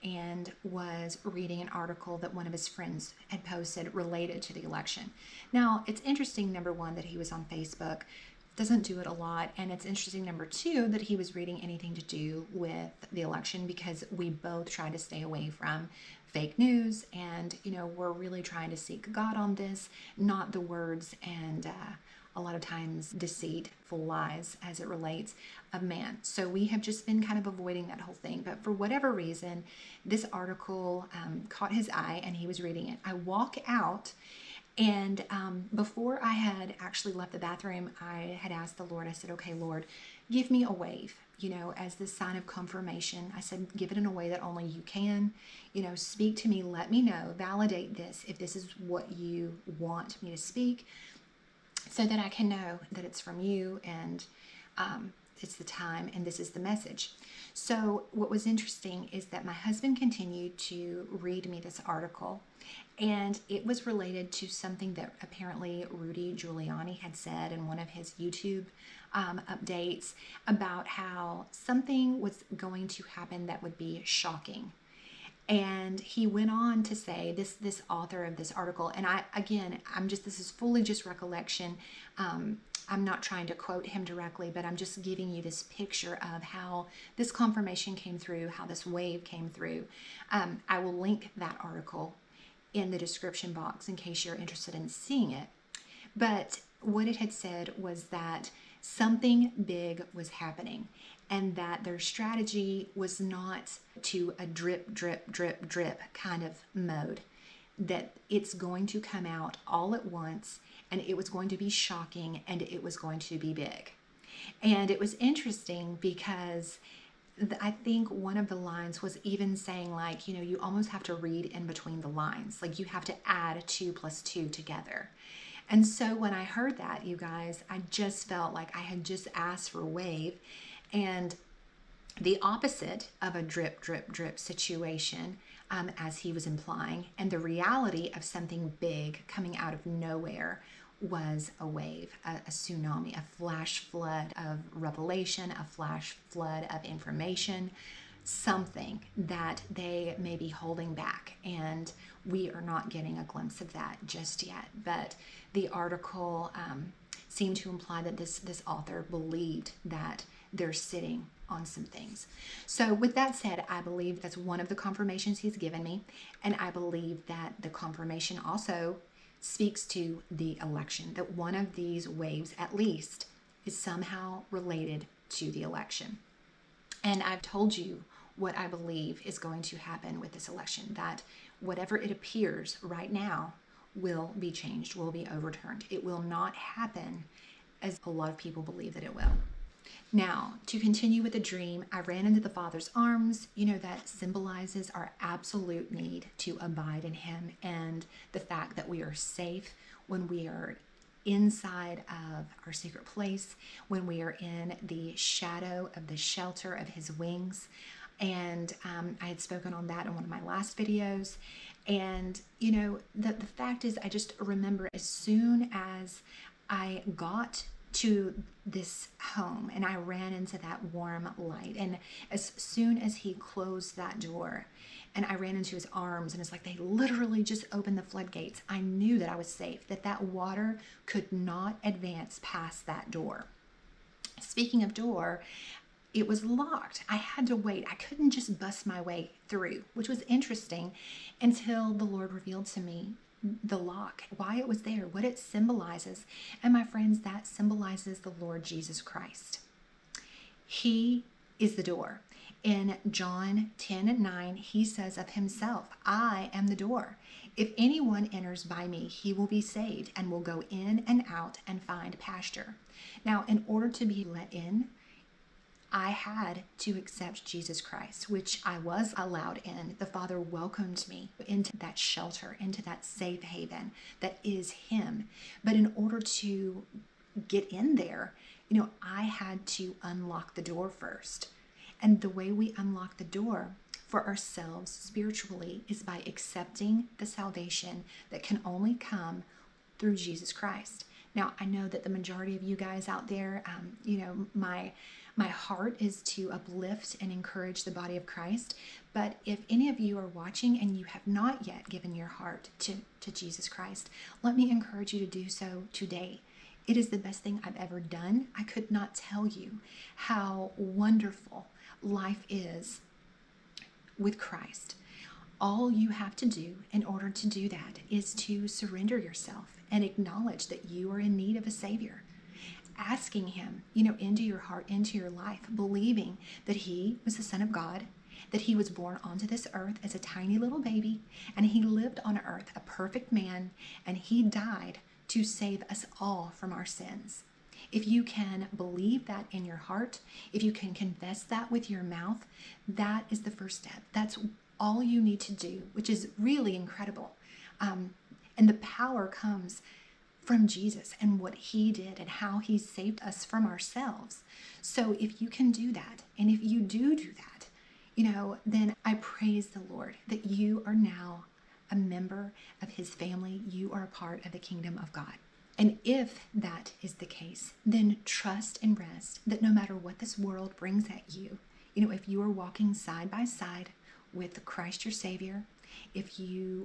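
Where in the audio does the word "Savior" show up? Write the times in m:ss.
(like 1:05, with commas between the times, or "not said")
5:21, 6:15.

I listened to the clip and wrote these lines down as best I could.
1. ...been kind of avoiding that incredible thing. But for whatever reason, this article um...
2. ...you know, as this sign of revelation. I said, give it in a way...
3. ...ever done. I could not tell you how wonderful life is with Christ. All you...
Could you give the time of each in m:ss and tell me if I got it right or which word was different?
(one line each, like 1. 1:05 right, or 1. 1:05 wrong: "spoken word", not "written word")
1. 0:27 wrong: "whole", not "incredible"
2. 0:41 wrong: "confirmation", not "revelation"
3. 5:07 right.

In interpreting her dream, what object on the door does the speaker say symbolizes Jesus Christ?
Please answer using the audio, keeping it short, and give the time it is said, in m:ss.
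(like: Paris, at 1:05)
the lock, at 4:03.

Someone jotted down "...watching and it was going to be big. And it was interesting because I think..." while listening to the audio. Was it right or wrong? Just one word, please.
wrong.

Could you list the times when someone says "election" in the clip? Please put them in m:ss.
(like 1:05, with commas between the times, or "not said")
0:04, 0:13, 2:50, 2:55, 3:00.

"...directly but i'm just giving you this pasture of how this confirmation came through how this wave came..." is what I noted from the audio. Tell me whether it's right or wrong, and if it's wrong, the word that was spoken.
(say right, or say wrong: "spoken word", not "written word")
wrong: "picture", not "pasture".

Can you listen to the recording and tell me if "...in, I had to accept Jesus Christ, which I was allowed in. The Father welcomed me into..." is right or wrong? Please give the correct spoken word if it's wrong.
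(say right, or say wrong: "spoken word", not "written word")
right.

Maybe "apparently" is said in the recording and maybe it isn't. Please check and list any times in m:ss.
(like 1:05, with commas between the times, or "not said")
1:05.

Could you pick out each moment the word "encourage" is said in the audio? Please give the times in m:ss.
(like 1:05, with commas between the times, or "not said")
4:57, 5:04.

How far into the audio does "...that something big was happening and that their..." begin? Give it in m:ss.
1:38.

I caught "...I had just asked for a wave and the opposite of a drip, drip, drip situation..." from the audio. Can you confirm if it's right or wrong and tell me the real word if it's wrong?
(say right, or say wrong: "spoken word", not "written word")
right.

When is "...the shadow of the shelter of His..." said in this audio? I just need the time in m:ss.
3:24.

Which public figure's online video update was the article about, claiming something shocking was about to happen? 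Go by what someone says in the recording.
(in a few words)
Rudy Giuliani.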